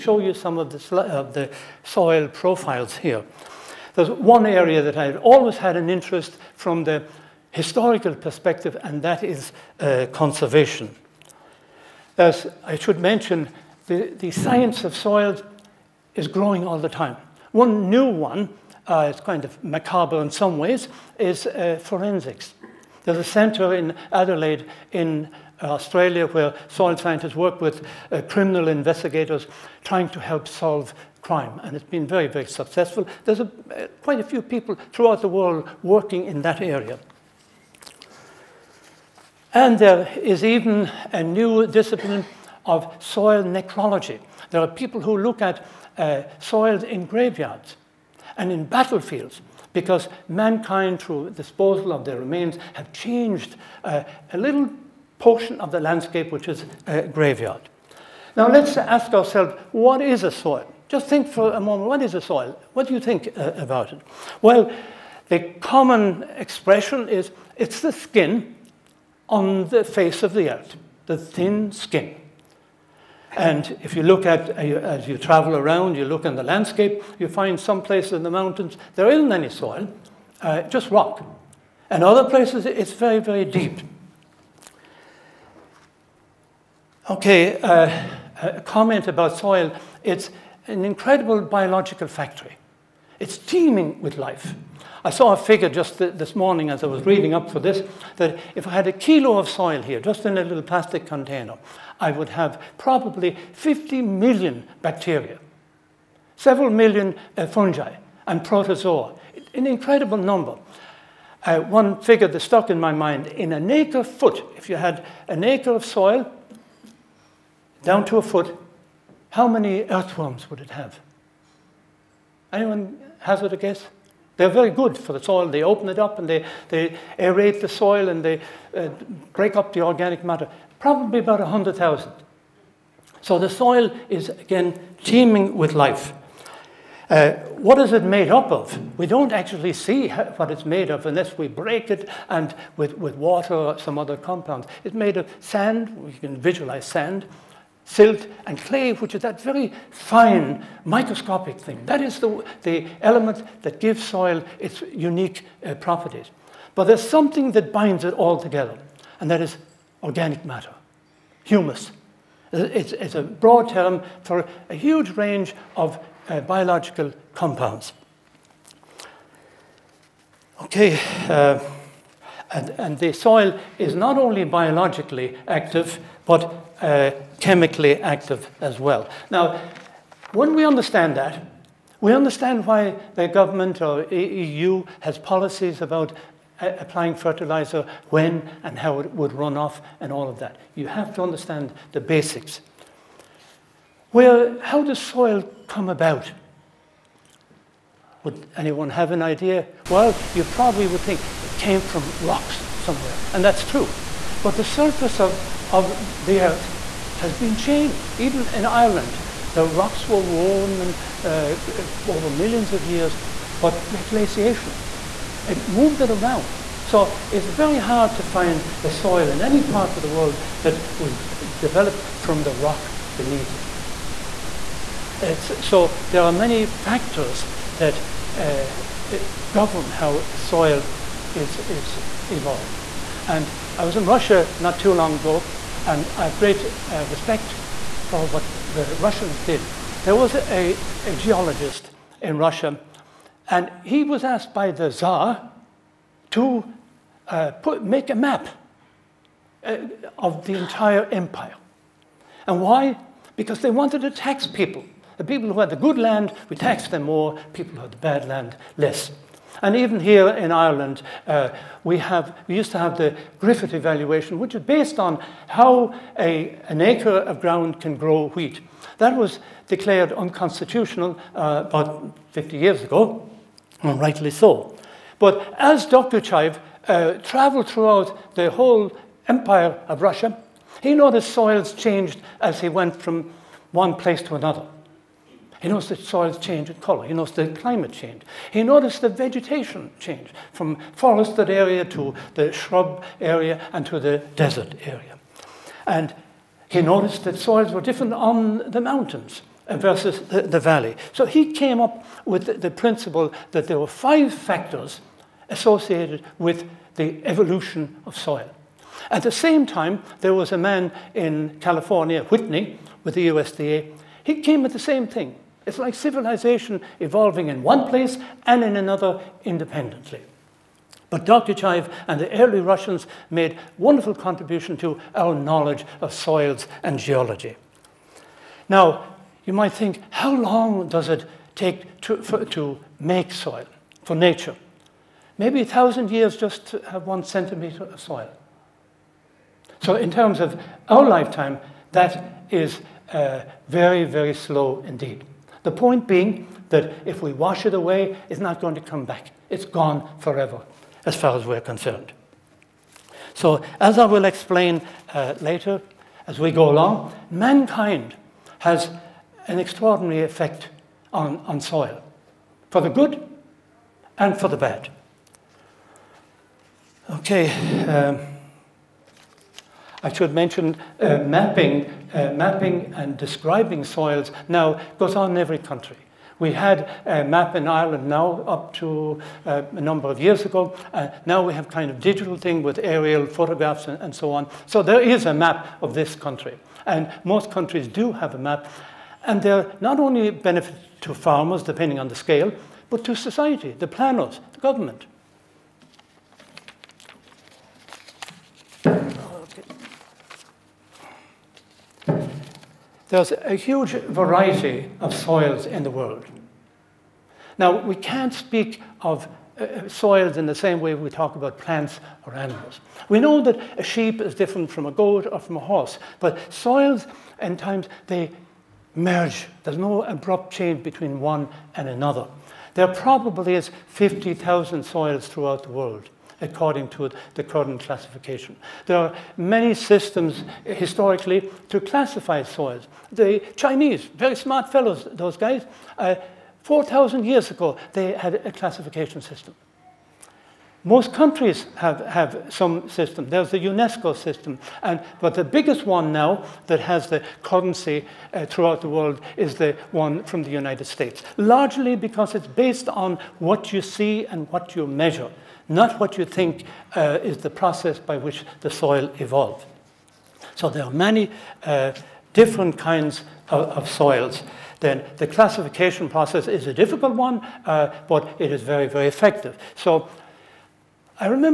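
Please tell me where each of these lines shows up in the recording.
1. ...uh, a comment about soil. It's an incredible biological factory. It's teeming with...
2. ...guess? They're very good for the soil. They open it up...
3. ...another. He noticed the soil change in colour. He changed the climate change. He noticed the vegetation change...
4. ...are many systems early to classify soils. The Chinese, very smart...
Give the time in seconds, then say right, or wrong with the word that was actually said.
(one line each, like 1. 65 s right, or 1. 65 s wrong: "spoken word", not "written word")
1. 87 s right
2. 123 s right
3. 284 s wrong: "noticed", not "changed"
4. 428 s wrong: "historically", not "early".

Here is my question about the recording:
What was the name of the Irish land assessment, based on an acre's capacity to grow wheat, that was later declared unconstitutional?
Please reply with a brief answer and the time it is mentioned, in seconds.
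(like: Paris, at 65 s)
Griffith evaluation, at 263 s.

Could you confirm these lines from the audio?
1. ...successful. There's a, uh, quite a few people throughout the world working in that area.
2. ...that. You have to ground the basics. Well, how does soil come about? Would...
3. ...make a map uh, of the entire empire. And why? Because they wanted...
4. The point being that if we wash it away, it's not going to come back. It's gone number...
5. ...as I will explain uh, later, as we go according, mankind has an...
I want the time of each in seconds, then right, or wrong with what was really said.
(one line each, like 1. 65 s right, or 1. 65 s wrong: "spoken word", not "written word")
1. 32 s right
2. 190 s wrong: "understand", not "ground"
3. 247 s right
4. 345 s wrong: "forever", not "number"
5. 353 s wrong: "along", not "according".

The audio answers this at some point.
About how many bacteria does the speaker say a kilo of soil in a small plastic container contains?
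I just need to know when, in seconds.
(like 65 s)
103 s.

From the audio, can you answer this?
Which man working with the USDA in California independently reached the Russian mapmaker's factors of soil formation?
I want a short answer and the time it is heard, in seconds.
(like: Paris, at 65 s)
Whitney, at 312 s.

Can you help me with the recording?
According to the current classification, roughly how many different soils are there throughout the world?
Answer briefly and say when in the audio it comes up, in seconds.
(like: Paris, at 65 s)
50,000, at 423 s.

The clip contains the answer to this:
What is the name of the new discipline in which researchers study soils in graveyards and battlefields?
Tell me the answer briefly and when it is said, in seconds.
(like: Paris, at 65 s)
soil necrology, at 43 s.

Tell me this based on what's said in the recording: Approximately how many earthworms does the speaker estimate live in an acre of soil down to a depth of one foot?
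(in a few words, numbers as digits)
100,000.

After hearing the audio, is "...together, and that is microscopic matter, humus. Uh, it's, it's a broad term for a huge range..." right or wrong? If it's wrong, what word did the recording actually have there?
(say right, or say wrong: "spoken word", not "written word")
wrong: "organic", not "microscopic".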